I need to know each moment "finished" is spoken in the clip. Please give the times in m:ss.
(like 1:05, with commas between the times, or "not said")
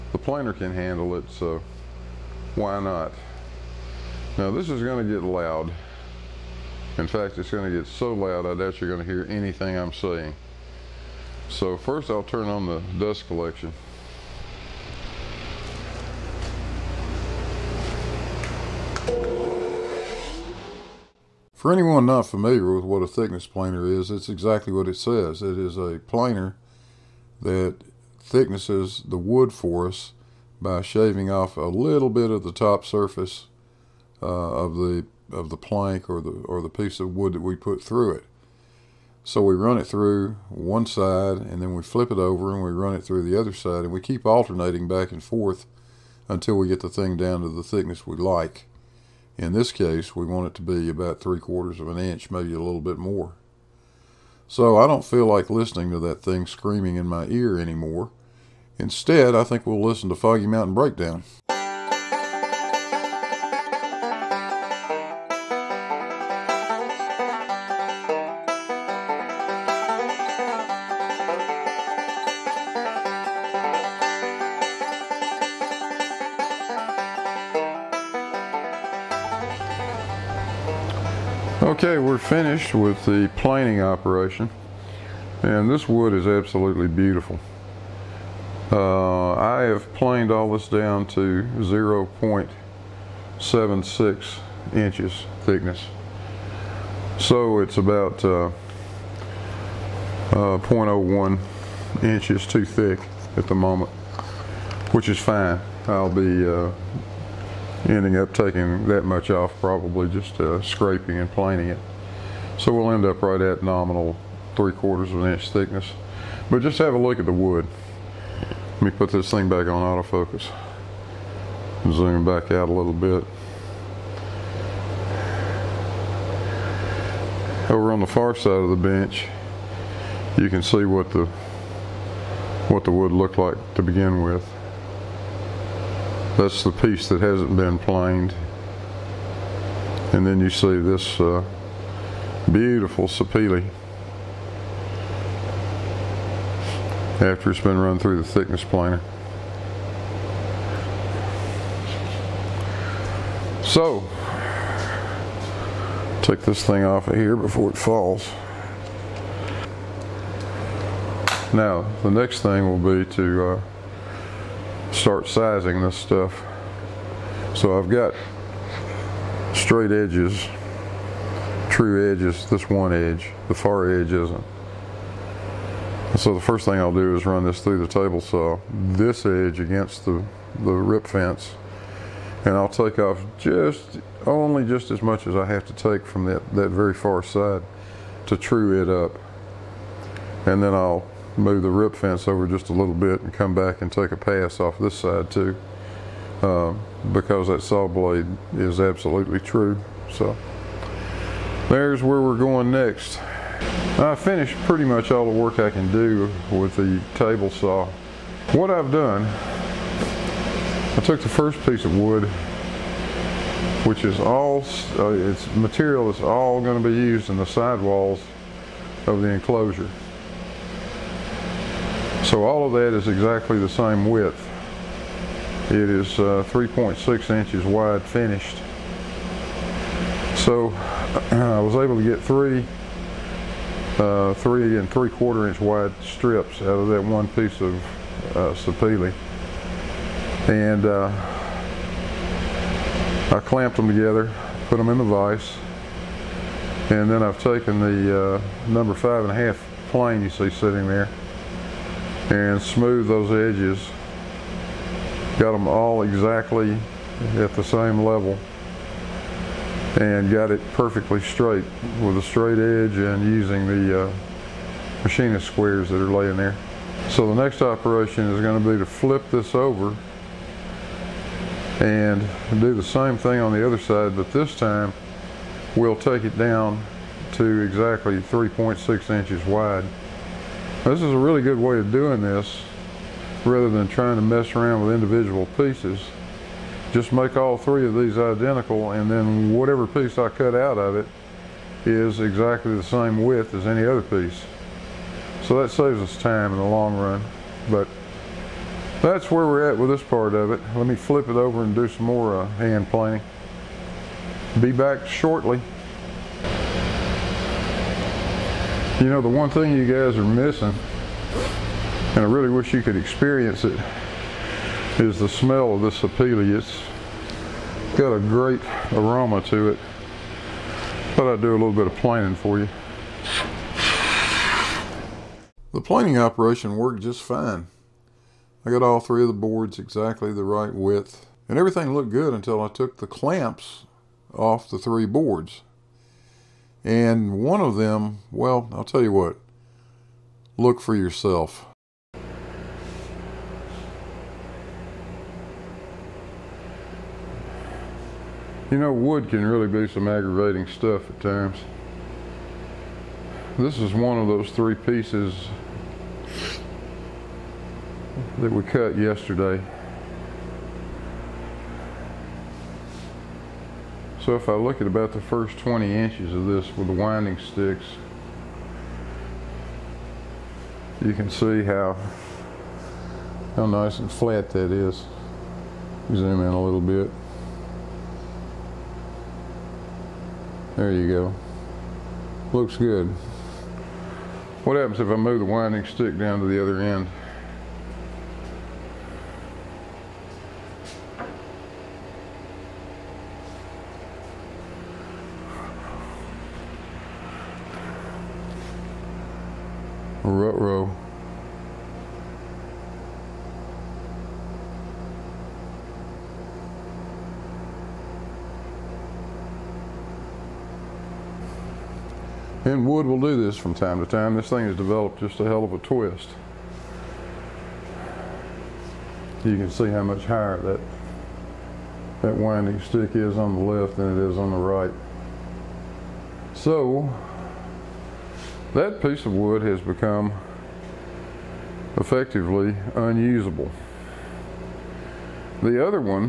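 1:22, 3:24, 3:48.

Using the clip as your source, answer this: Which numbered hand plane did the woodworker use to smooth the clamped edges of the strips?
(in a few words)
number five and a half.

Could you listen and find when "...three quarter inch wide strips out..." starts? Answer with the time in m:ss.
3:54.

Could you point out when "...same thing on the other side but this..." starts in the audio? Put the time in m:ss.
4:32.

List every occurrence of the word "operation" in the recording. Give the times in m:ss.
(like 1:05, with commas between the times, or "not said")
1:23, 4:27, 5:26.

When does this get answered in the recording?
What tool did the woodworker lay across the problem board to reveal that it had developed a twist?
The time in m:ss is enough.
6:06.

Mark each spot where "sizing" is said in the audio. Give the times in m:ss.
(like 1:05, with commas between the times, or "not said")
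2:45.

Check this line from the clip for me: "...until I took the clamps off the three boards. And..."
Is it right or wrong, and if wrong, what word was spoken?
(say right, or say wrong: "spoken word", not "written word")
right.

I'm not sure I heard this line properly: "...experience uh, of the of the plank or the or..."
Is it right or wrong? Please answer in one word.
wrong.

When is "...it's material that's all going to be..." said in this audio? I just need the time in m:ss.
3:35.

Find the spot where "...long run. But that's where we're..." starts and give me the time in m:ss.
4:56.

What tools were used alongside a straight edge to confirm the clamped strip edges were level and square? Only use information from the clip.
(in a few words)
machinist squares.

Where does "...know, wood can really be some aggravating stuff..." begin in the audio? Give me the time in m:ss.
5:48.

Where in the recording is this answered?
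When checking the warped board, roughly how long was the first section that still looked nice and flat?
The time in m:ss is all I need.
6:05.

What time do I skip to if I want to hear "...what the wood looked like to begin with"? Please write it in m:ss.
2:12.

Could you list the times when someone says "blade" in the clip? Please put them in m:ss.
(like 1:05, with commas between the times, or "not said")
3:17.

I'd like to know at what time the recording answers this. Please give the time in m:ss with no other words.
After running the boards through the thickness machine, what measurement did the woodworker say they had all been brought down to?
1:31.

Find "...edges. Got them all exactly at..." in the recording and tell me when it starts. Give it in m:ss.
4:13.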